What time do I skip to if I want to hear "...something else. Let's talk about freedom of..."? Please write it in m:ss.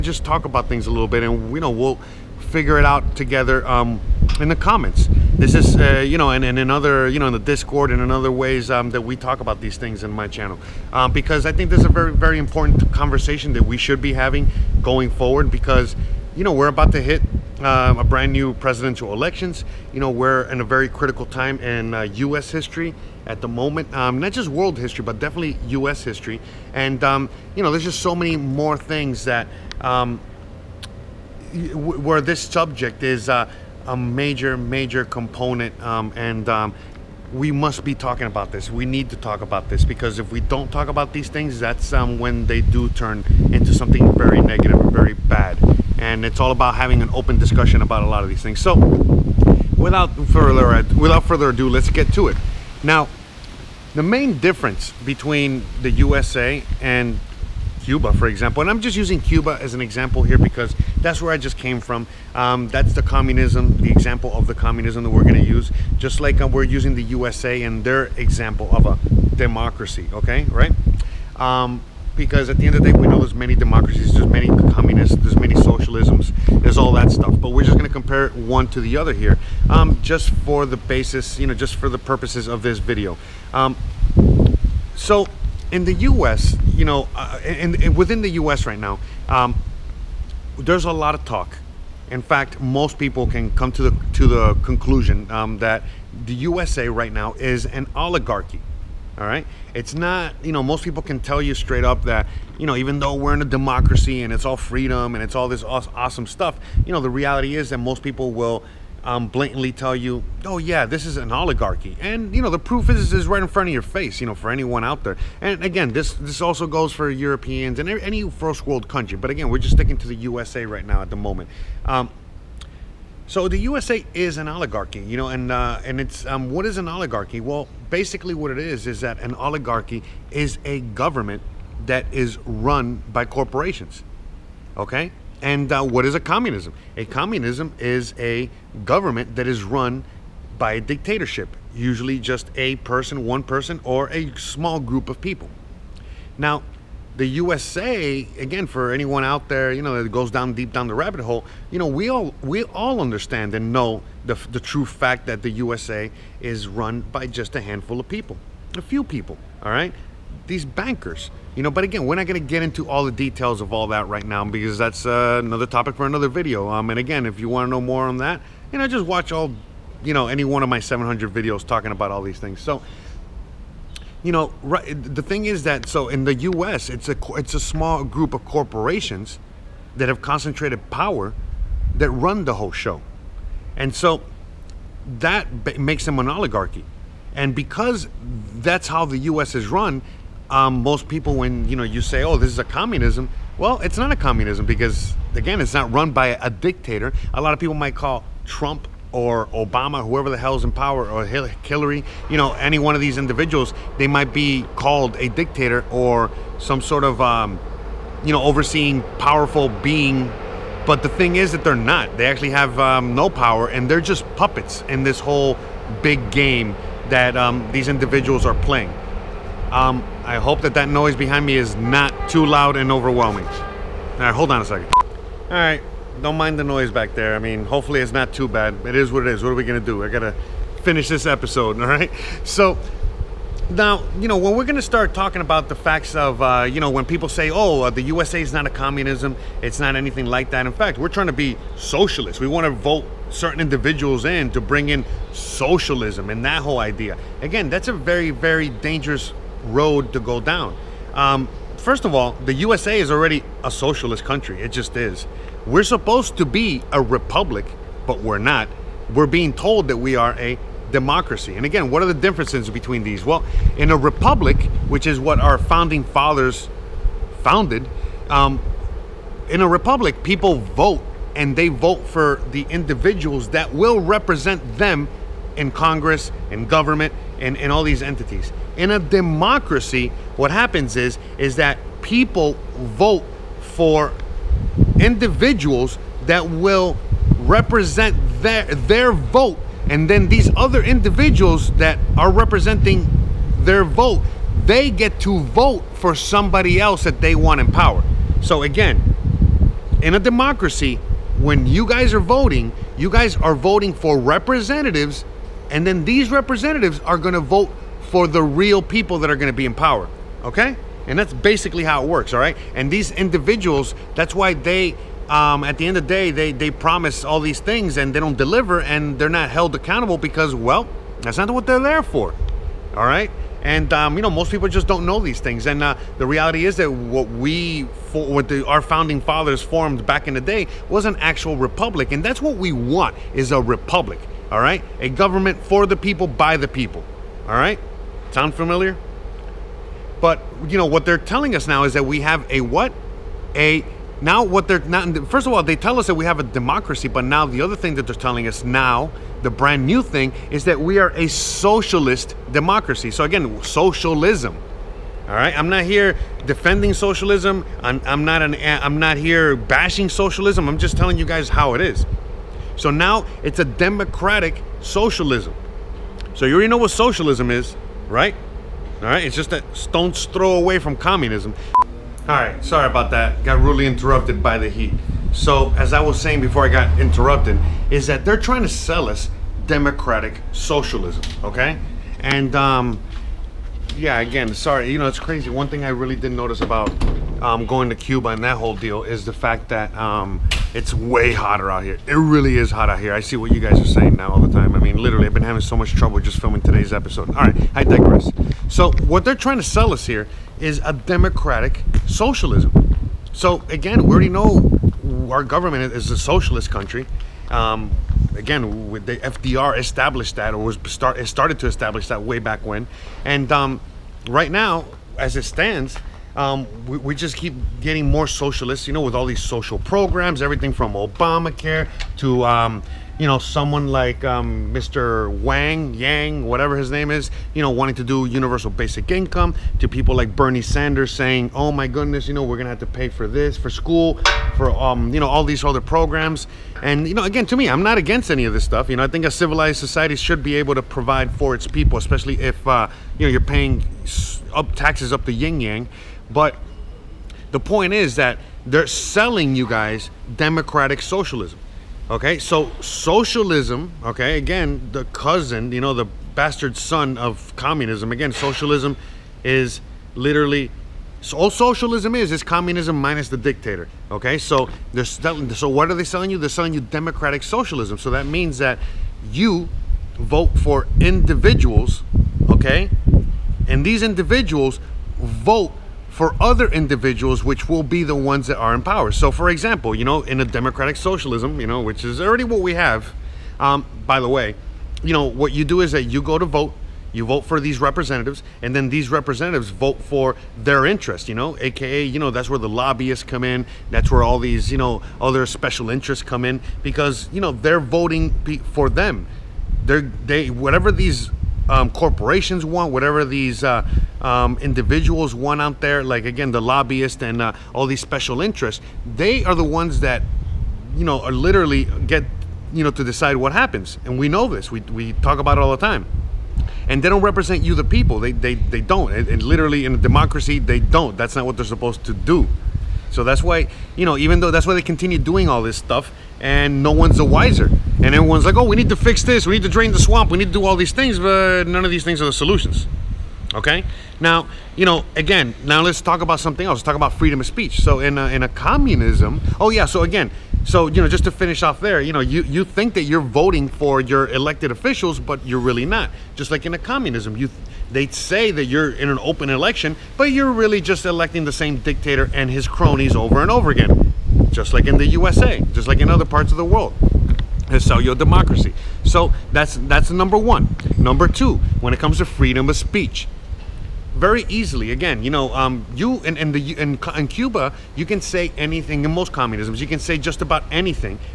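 8:56.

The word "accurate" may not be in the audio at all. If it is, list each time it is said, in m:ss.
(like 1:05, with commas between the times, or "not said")
not said.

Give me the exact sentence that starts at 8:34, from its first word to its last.
And we know this, we, we talk about it all the time.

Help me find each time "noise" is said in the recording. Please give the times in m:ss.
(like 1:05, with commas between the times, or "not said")
3:40, 3:46.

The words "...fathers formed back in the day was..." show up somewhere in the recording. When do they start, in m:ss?
5:29.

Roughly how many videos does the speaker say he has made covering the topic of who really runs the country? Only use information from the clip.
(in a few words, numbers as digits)
700.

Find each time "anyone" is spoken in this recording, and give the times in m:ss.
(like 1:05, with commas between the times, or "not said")
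1:54, 2:28.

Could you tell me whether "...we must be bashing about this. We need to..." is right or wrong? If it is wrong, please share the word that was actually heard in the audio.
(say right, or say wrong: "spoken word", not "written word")
wrong: "talking", not "bashing".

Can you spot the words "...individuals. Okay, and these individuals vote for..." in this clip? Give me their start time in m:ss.
7:50.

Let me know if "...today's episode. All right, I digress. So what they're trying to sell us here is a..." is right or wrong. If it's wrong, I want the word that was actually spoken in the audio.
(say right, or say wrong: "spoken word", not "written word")
right.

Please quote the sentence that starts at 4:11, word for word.
Um, first of all, the USA is already a socialist country.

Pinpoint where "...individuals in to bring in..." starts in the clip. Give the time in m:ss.
4:03.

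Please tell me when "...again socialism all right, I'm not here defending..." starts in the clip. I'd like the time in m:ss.
5:53.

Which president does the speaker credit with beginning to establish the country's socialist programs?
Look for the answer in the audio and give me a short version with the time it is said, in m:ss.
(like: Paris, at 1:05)
FDR, at 6:49.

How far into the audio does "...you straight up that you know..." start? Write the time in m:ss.
1:41.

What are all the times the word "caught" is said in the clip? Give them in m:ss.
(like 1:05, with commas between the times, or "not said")
not said.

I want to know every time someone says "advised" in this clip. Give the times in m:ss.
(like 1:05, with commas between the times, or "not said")
not said.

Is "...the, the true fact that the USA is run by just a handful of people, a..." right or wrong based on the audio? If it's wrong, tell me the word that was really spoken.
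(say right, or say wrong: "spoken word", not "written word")
right.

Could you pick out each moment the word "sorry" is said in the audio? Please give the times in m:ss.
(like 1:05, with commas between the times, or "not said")
6:12, 6:24.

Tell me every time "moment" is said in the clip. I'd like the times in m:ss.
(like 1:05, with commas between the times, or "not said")
0:23, 2:01.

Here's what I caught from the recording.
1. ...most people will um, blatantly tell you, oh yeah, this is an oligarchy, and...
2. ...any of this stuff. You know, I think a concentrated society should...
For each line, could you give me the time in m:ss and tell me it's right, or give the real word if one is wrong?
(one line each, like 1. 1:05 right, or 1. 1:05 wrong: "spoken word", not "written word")
1. 1:47 right
2. 7:18 wrong: "civilized", not "concentrated".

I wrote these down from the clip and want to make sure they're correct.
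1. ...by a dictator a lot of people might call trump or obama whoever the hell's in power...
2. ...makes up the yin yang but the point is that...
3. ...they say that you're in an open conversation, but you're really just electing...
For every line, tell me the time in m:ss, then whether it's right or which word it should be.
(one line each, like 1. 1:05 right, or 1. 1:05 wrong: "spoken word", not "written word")
1. 3:16 right
2. 7:24 wrong: "taxes", not "makes"
3. 9:07 wrong: "election", not "conversation".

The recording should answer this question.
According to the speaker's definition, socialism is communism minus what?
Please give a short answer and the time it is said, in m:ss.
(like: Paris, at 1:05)
the dictator, at 7:43.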